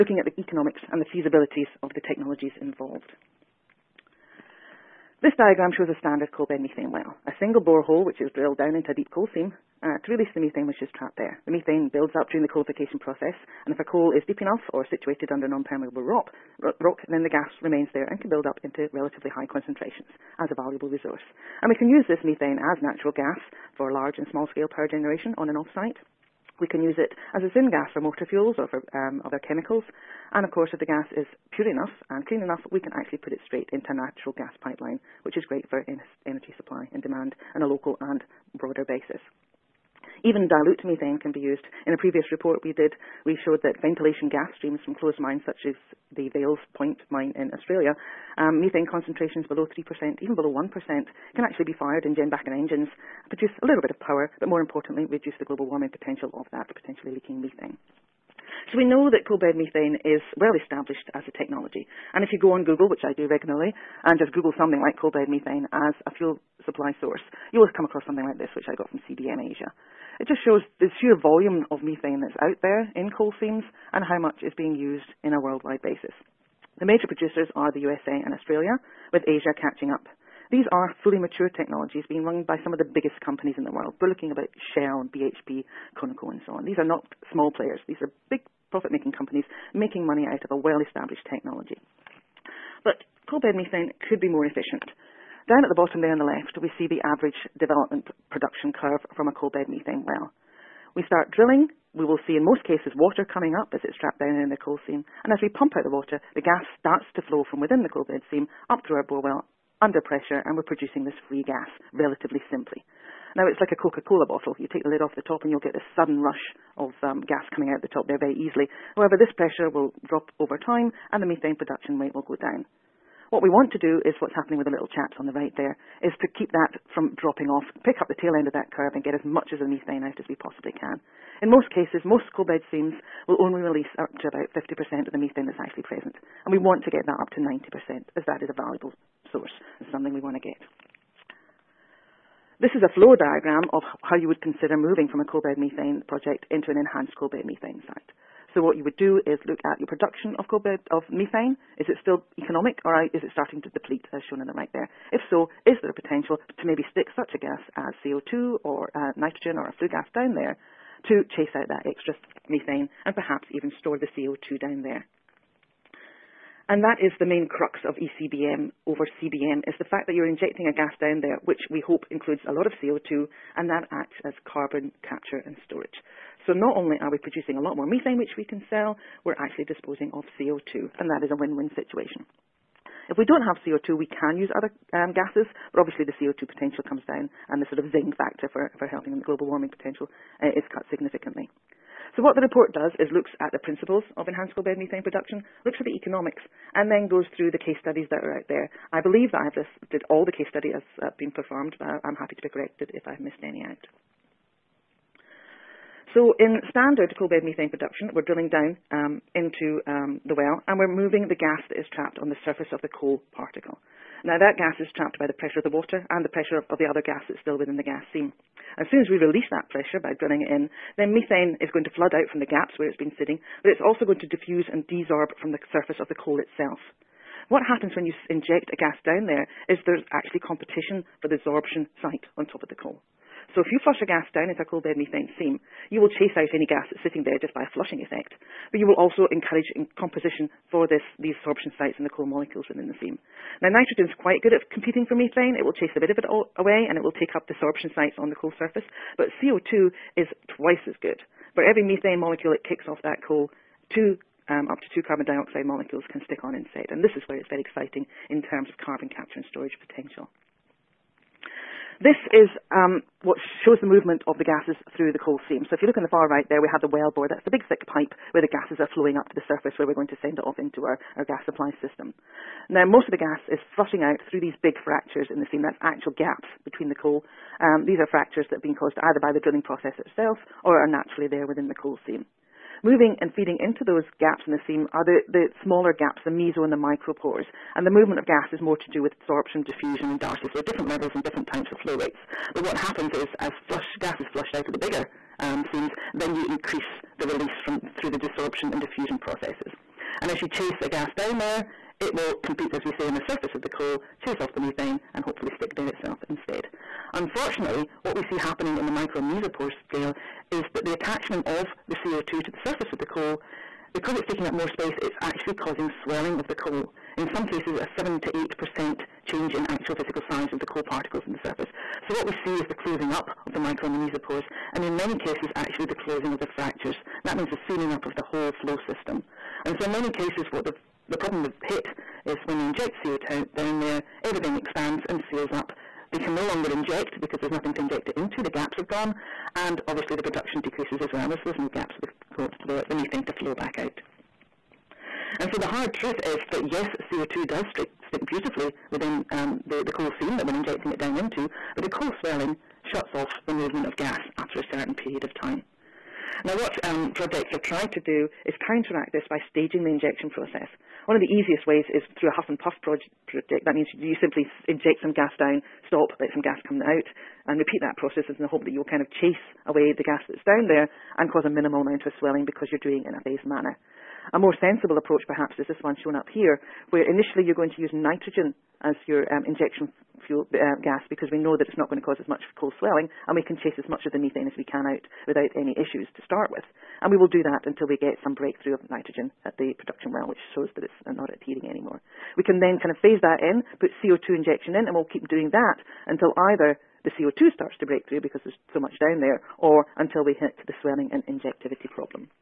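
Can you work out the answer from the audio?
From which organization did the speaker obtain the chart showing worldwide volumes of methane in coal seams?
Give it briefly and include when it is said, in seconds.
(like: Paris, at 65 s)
CBM Asia, at 69 s.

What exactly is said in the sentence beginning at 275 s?
That's actual gaps between the coal.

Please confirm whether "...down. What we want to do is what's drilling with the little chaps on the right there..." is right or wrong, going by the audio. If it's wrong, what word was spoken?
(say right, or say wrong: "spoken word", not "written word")
wrong: "happening", not "drilling".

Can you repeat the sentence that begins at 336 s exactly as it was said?
They can no longer inject because there's nothing to inject it into.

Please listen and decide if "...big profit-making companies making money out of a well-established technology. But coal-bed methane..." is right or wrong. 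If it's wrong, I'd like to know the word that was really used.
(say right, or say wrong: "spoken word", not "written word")
right.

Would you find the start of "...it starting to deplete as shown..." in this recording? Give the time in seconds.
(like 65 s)
153 s.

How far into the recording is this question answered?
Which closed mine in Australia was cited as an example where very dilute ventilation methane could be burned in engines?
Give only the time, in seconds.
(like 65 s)
46 s.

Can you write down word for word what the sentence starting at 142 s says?
This is a flow diagram of how you would consider moving from a coal-bed methane project into an enhanced coal-bed methane site.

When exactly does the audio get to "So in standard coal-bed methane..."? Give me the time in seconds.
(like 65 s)
206 s.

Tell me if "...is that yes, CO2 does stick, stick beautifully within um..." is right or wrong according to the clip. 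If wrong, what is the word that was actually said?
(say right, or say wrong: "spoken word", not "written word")
right.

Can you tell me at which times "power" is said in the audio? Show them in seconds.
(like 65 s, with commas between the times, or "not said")
24 s, 53 s.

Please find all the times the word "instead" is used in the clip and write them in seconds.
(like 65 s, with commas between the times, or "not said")
256 s, 306 s.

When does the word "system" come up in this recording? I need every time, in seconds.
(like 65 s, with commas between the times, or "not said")
271 s, 328 s.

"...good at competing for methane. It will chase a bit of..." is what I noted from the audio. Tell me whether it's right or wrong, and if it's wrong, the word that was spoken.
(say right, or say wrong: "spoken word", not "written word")
right.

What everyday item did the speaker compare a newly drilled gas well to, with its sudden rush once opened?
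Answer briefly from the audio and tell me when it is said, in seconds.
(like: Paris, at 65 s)
Coca-Cola bottle, at 113 s.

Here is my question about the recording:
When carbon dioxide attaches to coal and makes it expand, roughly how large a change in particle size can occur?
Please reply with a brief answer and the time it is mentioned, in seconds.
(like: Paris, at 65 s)
7 to 8 percent, at 317 s.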